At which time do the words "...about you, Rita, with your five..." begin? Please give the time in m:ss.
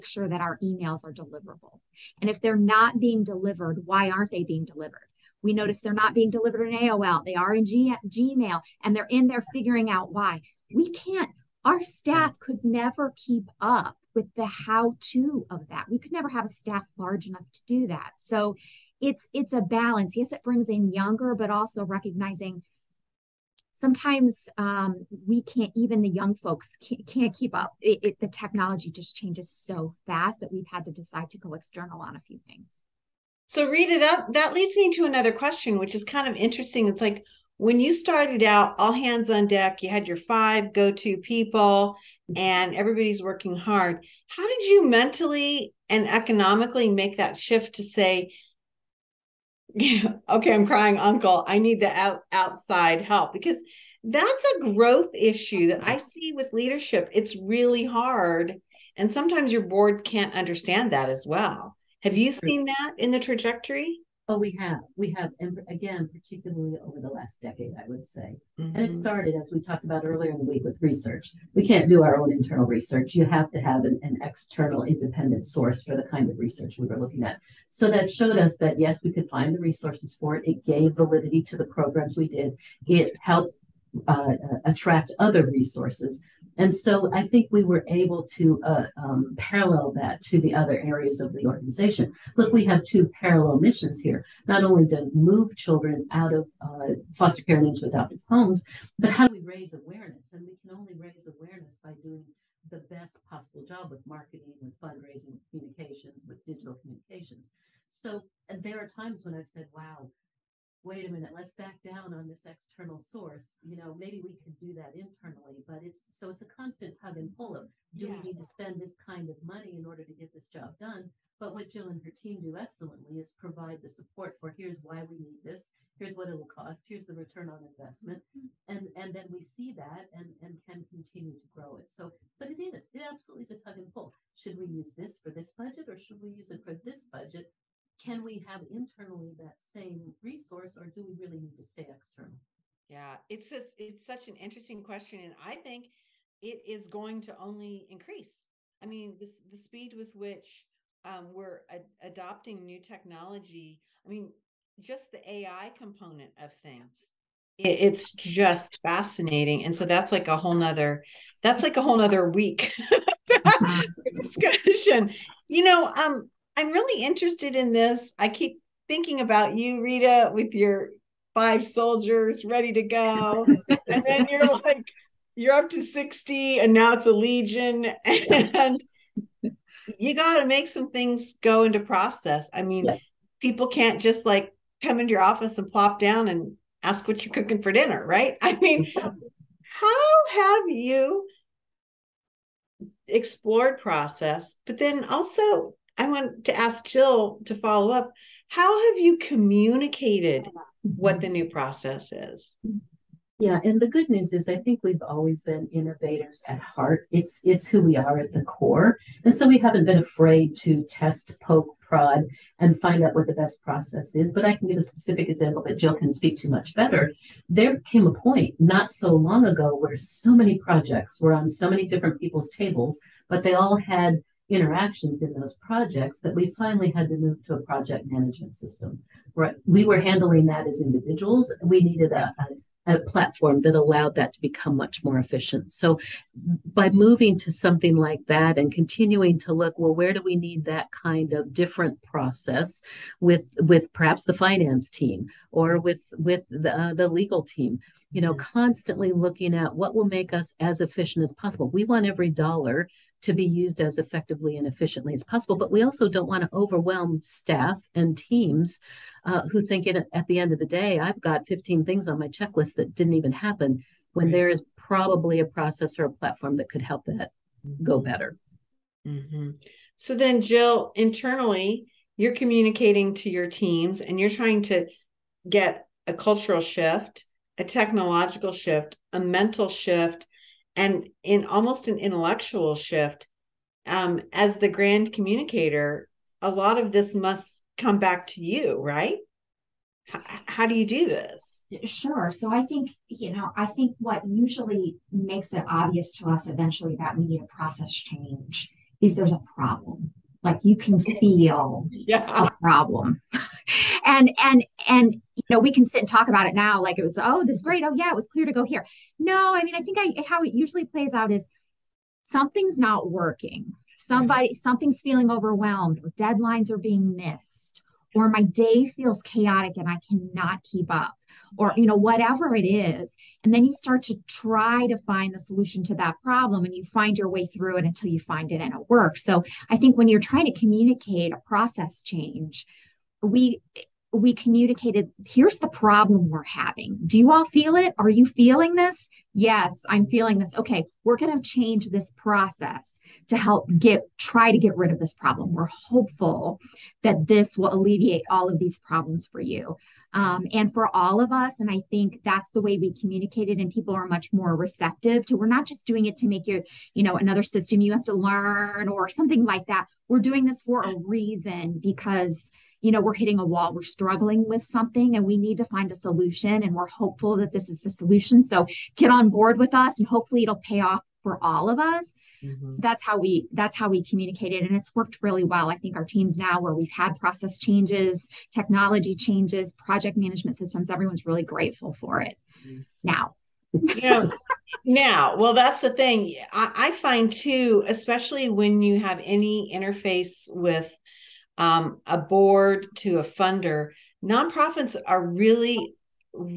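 2:49.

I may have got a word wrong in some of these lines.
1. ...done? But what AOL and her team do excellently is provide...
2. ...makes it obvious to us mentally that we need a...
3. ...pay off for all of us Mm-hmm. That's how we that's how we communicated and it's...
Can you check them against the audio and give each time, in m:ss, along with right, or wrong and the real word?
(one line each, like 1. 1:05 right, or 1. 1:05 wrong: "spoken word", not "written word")
1. 2:00 wrong: "Jill", not "AOL"
2. 4:55 wrong: "eventually", not "mentally"
3. 6:10 right.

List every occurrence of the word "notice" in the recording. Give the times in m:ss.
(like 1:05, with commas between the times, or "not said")
0:05.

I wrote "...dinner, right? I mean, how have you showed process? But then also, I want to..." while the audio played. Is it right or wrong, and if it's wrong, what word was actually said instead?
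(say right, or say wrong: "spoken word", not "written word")
wrong: "explored", not "showed".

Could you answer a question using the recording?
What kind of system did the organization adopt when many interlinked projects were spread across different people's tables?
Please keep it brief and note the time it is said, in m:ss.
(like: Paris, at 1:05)
Project management system, at 3:47.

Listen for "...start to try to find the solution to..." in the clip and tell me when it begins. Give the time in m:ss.
5:23.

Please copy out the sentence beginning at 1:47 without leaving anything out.
So there are times when I've said, wow, wait a minute, let's back down on this external source.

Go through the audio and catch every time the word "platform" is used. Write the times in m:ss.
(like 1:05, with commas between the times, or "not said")
3:53, 4:26.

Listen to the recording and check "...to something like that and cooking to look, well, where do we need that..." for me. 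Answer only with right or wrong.
wrong.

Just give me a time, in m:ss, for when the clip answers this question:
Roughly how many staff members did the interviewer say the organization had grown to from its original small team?
2:55.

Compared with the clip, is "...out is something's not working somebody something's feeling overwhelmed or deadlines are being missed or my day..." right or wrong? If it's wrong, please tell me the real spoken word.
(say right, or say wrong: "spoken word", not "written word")
right.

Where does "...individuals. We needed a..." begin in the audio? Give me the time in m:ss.
3:50.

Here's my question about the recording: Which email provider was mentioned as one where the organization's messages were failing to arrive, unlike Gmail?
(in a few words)
AOL.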